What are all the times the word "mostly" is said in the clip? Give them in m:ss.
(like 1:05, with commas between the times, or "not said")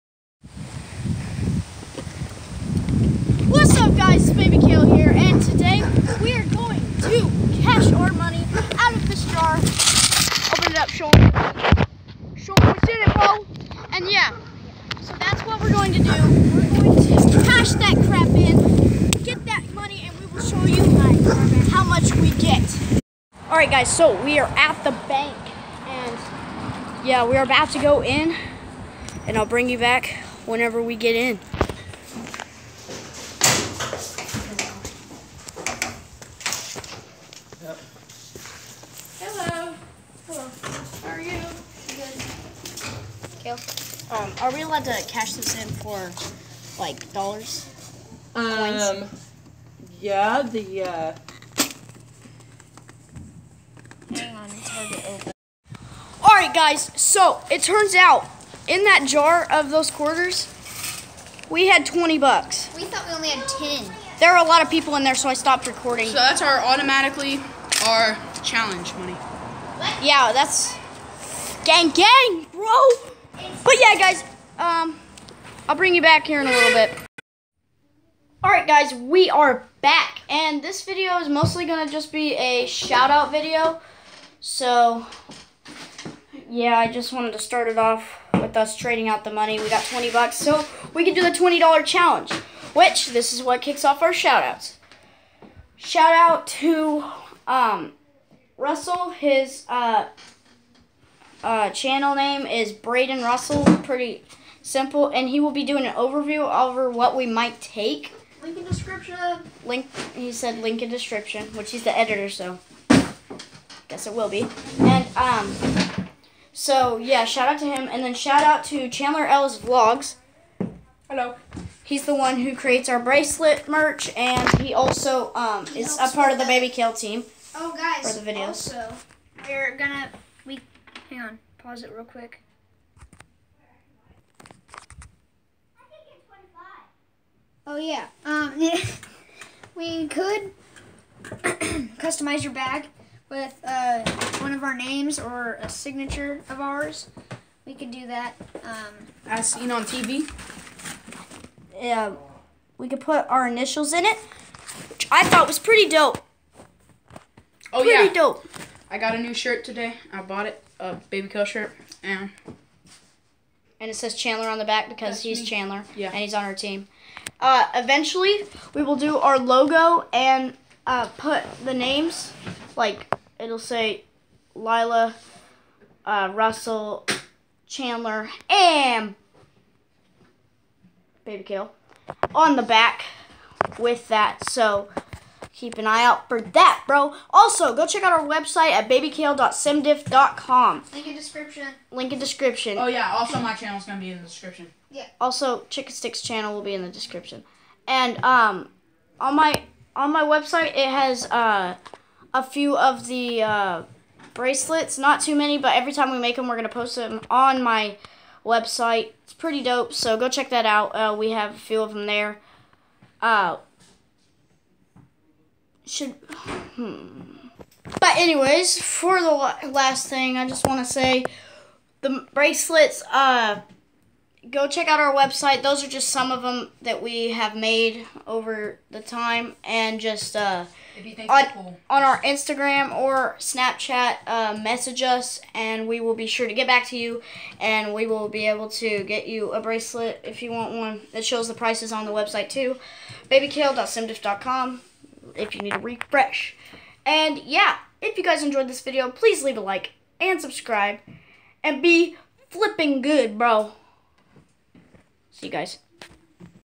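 1:21.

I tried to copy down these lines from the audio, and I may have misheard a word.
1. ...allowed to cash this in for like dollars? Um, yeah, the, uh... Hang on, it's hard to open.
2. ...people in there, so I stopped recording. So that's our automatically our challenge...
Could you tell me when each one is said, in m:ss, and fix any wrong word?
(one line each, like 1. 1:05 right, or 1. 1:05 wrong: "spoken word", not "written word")
1. 0:44 right
2. 1:04 right.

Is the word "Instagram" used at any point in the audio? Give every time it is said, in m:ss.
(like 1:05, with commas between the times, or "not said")
3:52.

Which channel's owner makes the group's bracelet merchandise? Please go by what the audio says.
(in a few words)
Chandler Ellis Vlogs.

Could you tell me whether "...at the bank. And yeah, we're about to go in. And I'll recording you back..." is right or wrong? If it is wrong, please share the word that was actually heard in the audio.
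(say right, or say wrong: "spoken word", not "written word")
wrong: "bring", not "recording".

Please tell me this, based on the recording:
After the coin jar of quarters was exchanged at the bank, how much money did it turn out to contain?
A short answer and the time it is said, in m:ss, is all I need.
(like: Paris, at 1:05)
$20, at 1:01.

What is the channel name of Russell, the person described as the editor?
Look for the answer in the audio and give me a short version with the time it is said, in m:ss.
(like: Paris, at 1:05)
Brayden Russell, at 1:42.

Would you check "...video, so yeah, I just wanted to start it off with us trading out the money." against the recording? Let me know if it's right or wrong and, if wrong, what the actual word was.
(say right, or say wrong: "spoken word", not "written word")
right.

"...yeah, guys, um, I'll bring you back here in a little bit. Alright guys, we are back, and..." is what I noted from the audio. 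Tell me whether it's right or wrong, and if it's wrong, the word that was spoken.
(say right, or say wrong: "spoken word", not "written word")
right.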